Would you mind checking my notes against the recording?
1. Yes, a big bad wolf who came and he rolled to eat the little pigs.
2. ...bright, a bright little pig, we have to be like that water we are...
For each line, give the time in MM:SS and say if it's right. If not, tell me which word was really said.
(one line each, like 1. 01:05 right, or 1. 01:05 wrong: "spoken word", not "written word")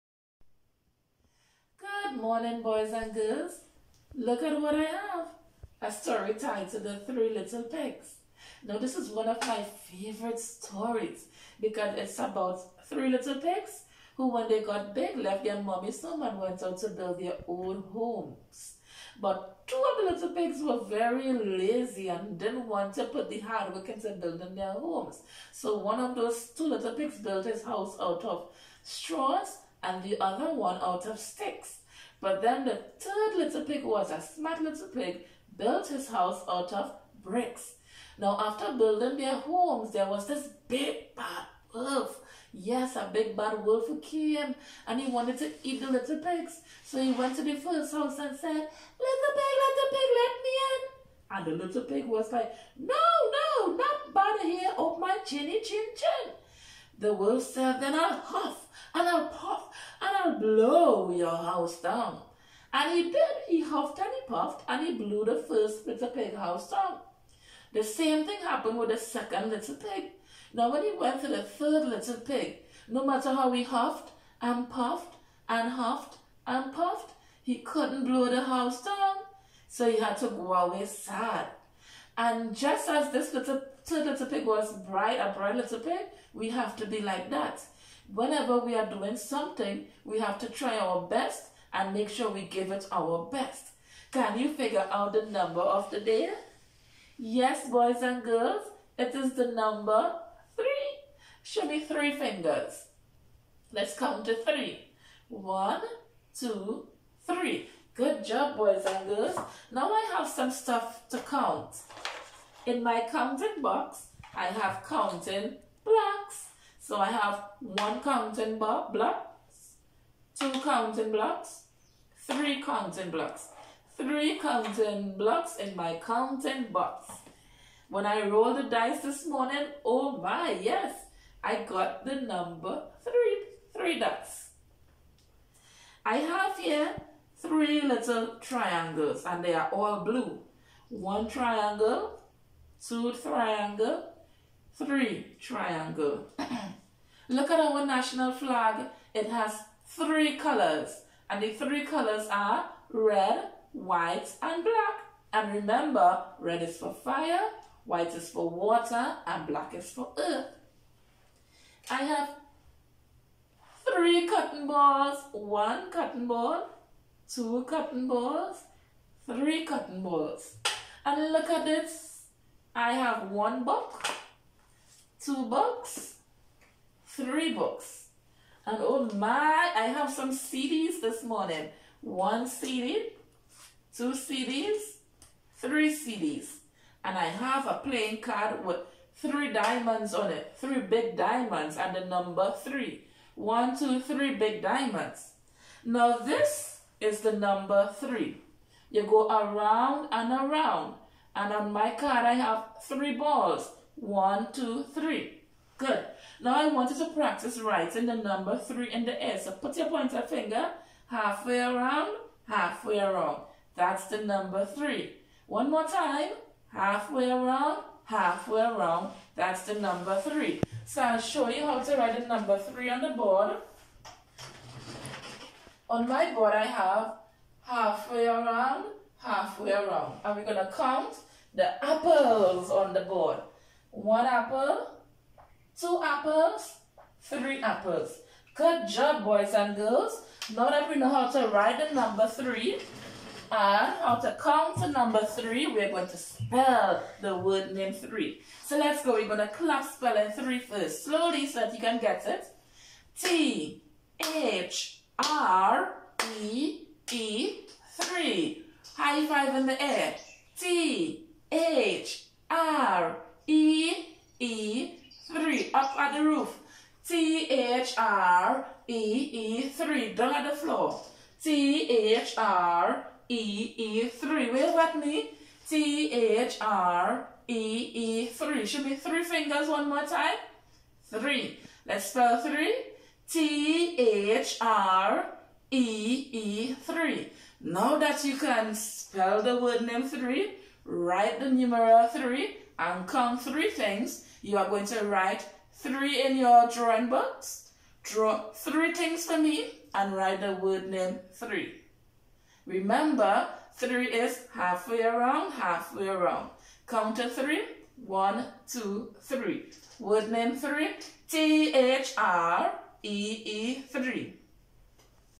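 1. 00:42 wrong: "wanted", not "rolled"
2. 01:24 wrong: "whenever", not "water".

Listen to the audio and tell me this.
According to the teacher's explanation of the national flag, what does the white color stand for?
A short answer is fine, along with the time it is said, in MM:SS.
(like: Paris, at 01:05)
water, at 02:38.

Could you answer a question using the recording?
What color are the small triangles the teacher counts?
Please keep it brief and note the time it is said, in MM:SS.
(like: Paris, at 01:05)
blue, at 02:20.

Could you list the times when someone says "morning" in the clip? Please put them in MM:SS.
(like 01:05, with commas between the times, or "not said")
00:02, 02:09, 03:01.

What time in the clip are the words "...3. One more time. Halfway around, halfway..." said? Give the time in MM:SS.
03:34.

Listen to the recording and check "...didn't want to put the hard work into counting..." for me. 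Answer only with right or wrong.
wrong.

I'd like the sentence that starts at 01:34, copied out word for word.
Can you figure out the number of the day?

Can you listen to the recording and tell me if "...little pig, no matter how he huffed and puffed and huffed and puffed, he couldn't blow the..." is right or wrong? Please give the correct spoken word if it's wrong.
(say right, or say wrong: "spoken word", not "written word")
right.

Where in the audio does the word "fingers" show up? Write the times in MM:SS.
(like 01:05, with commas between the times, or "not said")
01:42, 03:30, 04:39.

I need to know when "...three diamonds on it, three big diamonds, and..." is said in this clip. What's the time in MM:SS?
03:09.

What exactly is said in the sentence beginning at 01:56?
So I have one counting block, two counting blocks, three counting blocks, three counting blocks in my counting box.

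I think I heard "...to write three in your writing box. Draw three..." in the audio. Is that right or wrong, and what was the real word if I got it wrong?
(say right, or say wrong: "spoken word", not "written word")
wrong: "drawing", not "writing".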